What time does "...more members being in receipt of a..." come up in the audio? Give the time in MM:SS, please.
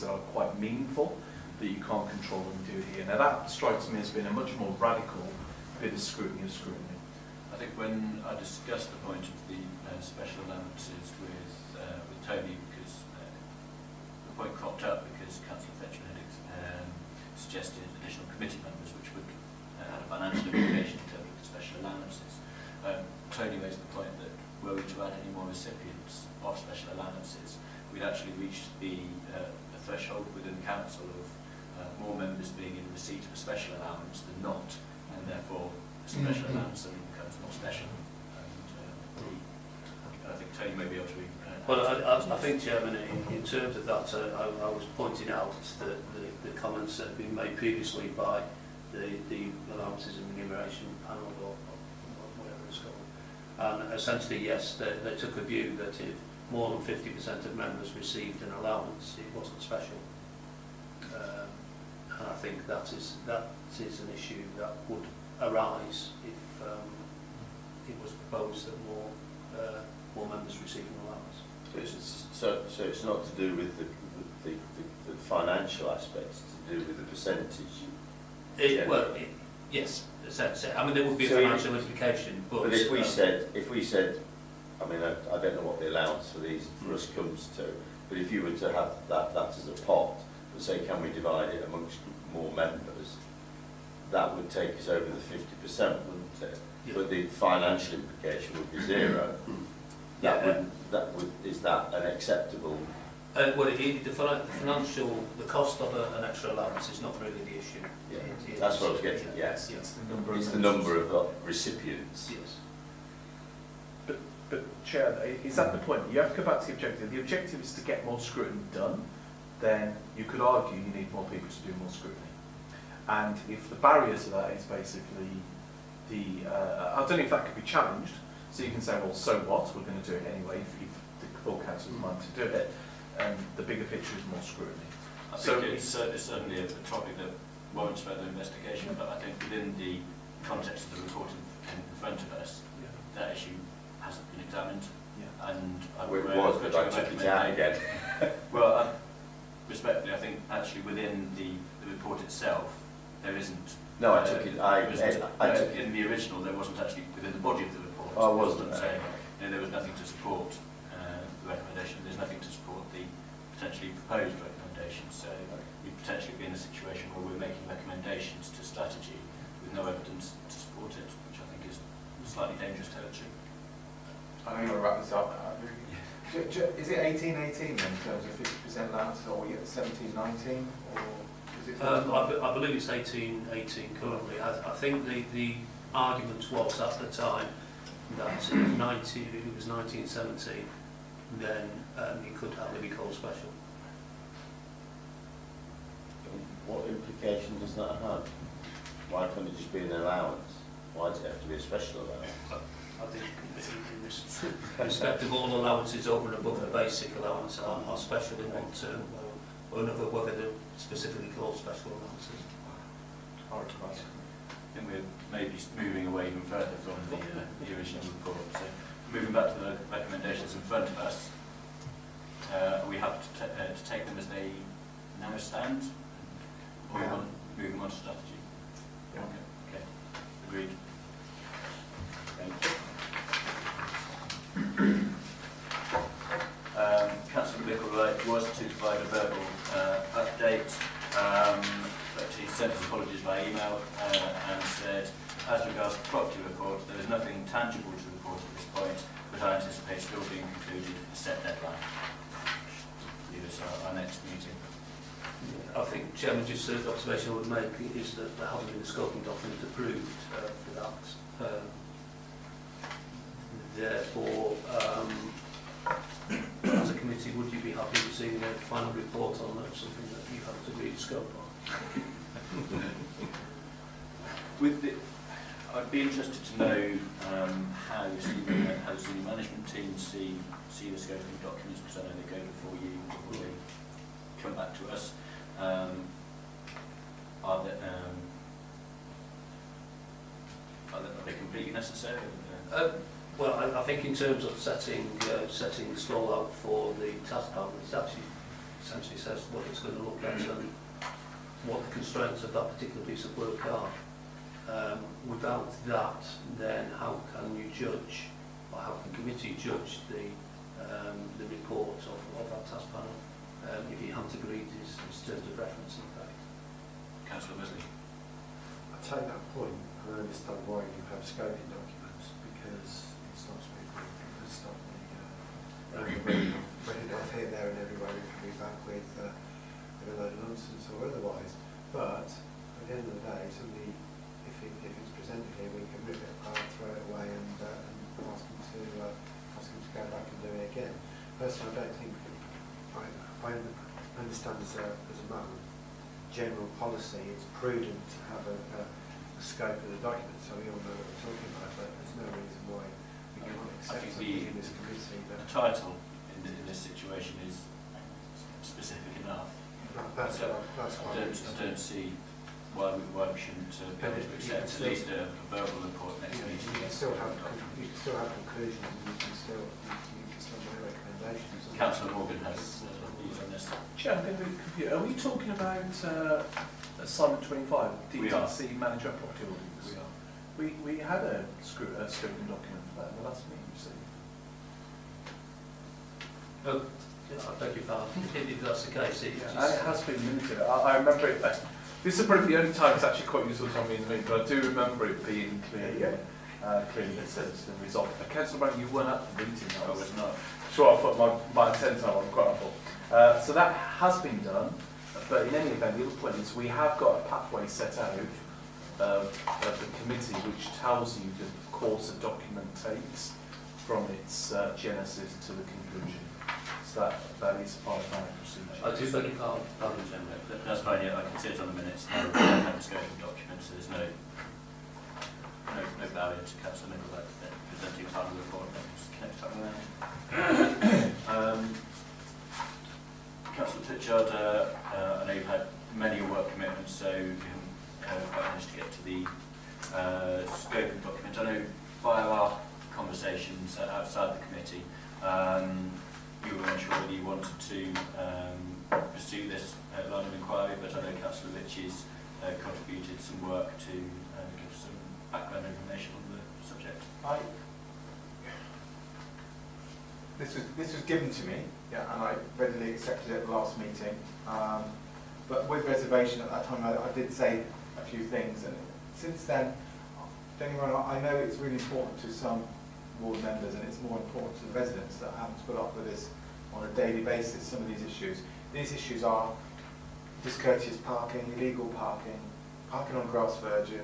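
00:32.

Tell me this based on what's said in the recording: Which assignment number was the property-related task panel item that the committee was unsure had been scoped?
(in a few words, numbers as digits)
25.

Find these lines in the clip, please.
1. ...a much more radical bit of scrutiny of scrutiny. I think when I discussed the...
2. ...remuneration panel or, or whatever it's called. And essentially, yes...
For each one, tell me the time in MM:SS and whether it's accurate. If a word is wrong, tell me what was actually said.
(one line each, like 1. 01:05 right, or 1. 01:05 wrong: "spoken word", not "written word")
1. 00:04 right
2. 00:50 right.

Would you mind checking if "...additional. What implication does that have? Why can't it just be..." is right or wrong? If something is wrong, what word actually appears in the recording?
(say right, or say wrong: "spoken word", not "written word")
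wrong: "special", not "additional".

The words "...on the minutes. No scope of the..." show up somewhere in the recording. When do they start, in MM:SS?
07:01.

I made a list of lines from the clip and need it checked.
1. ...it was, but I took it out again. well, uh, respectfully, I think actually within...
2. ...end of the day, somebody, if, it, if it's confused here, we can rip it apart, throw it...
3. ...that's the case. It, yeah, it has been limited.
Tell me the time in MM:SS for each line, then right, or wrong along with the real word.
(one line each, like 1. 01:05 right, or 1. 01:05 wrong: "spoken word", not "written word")
1. 02:26 right
2. 05:32 wrong: "presented", not "confused"
3. 06:28 right.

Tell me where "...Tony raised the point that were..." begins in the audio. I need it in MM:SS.
00:23.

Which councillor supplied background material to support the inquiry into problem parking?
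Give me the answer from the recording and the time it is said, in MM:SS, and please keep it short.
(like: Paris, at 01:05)
Councillor Ritchie, at 07:31.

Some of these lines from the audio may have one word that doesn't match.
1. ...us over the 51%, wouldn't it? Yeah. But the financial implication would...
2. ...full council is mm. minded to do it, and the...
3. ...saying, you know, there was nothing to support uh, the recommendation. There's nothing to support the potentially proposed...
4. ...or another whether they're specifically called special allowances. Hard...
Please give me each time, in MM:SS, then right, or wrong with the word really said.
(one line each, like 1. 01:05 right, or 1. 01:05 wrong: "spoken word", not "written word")
1. 01:34 wrong: "50", not "51"
2. 02:11 right
3. 02:38 right
4. 03:29 right.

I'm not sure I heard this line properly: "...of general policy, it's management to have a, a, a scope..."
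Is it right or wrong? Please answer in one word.
wrong.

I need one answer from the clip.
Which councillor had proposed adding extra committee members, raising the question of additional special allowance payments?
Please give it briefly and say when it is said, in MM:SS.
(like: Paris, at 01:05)
Councillor Fletcher, at 00:15.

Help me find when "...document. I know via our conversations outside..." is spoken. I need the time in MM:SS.
07:21.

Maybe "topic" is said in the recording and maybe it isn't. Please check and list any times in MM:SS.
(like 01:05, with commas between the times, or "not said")
02:16.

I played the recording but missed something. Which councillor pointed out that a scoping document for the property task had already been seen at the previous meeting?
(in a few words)
Councillor Morgan.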